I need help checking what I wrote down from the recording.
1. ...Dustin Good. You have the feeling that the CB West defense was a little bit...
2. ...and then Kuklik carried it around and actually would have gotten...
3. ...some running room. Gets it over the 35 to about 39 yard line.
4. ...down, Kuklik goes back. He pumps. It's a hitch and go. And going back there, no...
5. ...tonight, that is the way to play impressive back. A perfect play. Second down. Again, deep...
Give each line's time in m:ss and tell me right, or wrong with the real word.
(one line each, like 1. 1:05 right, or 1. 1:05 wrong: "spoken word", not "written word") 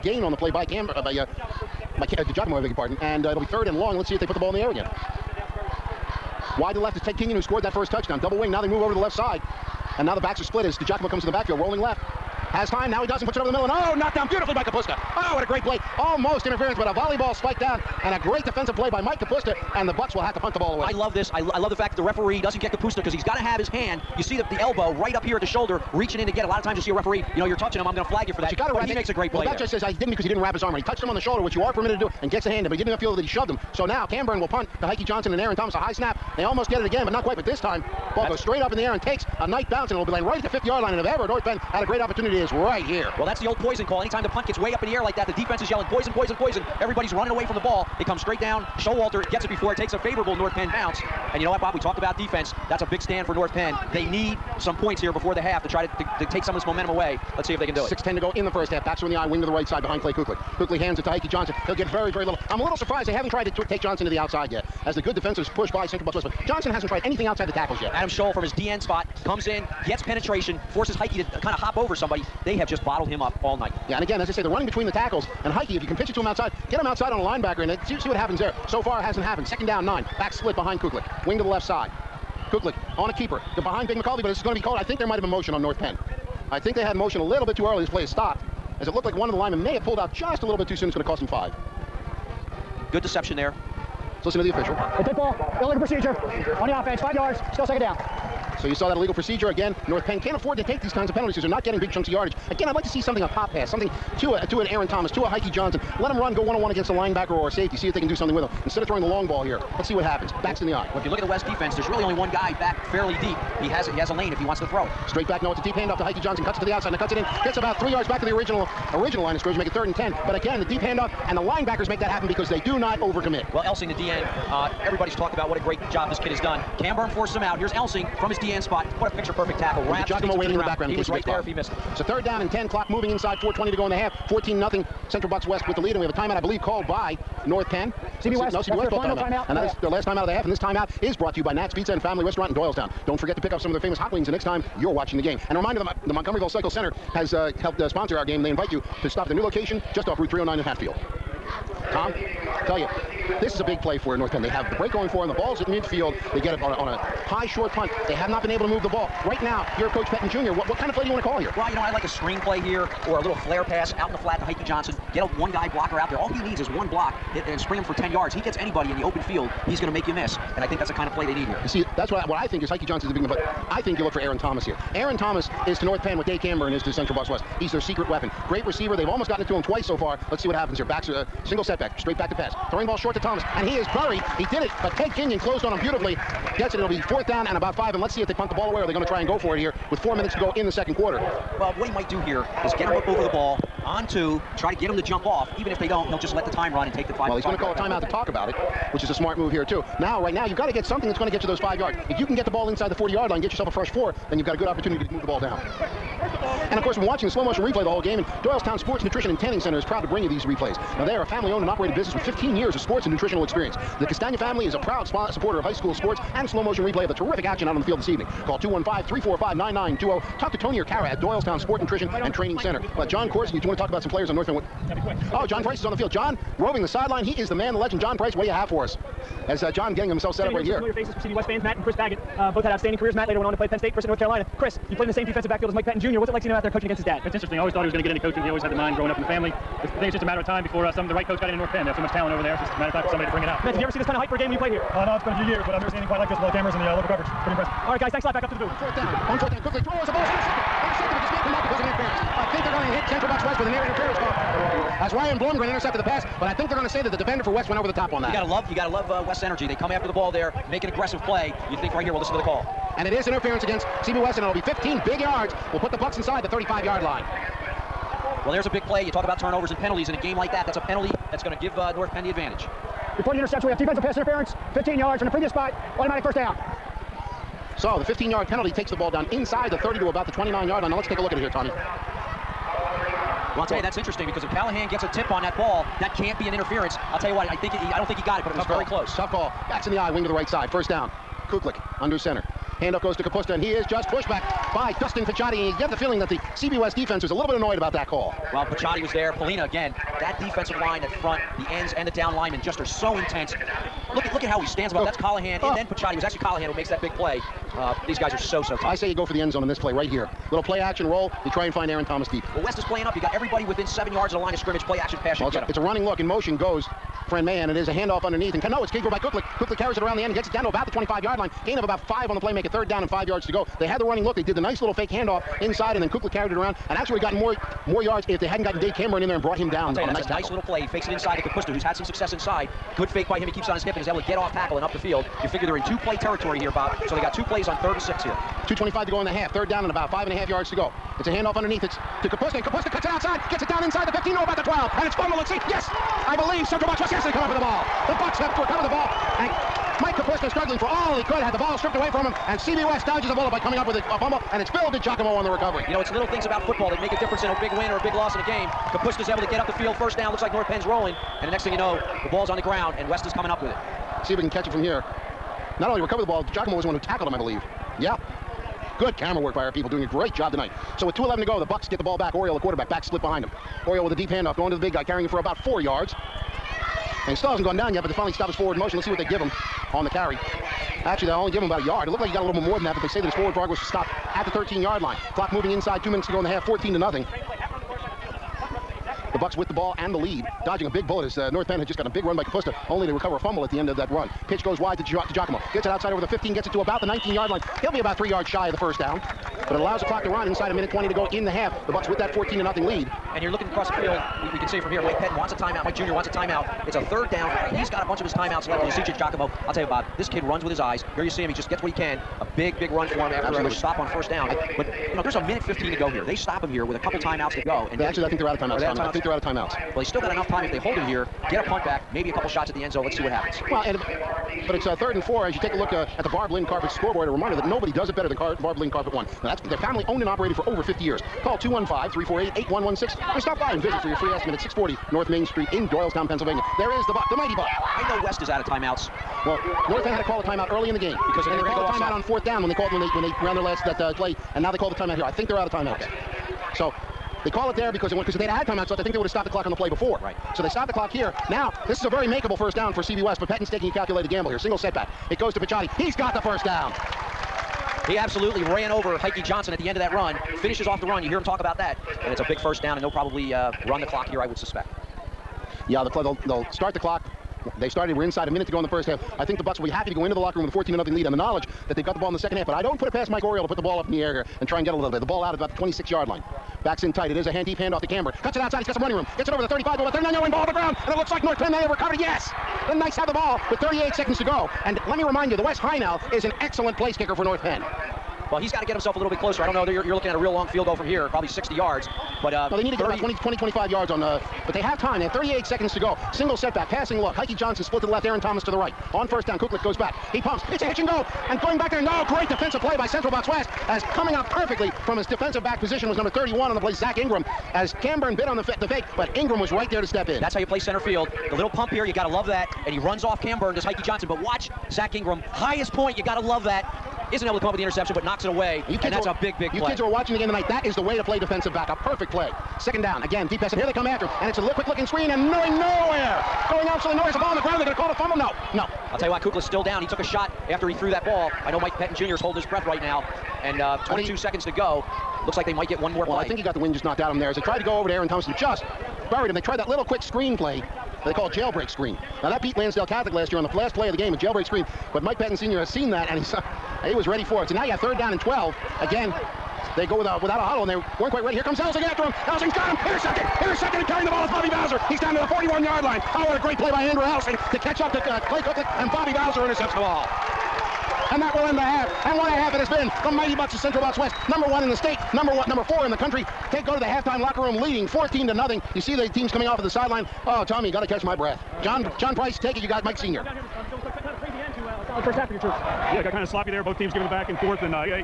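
1. 4:54 wrong: "Picciotti", not "Good"
2. 5:25 right
3. 7:58 right
4. 8:19 right
5. 8:40 wrong: "defensive", not "impressive".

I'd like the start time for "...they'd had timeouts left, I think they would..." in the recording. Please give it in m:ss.
7:28.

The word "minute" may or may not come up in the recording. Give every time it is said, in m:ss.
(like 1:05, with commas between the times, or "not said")
3:10, 6:26, 6:40, 6:55, 7:48.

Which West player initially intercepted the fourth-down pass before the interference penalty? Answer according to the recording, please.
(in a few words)
Ryan Blumgren.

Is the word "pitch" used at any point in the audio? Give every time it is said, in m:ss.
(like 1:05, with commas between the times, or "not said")
1:15, 6:34.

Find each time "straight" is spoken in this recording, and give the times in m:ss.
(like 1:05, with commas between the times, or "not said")
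0:38, 0:48, 1:55, 3:01.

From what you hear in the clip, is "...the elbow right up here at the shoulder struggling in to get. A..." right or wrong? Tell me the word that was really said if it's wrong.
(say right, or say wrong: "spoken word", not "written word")
wrong: "reaching", not "struggling".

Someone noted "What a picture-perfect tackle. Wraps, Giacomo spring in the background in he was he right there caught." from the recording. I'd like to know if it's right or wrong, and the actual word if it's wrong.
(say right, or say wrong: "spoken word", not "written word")
wrong: "waiting", not "spring".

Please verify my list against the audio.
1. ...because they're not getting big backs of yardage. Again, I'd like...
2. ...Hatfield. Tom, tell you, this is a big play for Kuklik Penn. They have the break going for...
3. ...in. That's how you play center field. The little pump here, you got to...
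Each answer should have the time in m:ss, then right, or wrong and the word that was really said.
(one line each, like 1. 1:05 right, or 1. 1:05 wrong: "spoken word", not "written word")
1. 1:41 wrong: "chunks", not "backs"
2. 2:30 wrong: "North", not "Kuklik"
3. 8:30 right.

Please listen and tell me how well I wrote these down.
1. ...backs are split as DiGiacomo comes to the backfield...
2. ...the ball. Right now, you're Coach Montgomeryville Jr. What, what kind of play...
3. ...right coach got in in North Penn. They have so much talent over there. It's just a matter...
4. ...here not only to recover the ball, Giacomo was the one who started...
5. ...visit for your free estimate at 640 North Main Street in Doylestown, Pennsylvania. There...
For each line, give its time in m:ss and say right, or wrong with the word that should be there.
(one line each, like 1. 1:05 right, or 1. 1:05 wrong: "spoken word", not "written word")
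1. 0:10 right
2. 2:38 wrong: "Pettine", not "Montgomeryville"
3. 4:01 right
4. 6:04 wrong: "tackled", not "started"
5. 7:13 right.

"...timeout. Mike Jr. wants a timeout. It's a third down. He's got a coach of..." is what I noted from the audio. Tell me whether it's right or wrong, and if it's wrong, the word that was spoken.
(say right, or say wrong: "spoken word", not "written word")
wrong: "bunch", not "coach".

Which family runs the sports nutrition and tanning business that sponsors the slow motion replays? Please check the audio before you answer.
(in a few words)
Castagna.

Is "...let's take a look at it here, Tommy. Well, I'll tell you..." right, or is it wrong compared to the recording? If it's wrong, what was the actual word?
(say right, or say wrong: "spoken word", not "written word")
right.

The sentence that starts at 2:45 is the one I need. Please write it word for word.
Get a one guy blocker out there.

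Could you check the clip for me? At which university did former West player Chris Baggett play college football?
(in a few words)
North Carolina.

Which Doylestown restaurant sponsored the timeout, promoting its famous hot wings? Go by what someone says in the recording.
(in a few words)
Nat's Pizza and Family Restaurant.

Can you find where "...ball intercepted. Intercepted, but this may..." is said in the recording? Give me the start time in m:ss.
4:10.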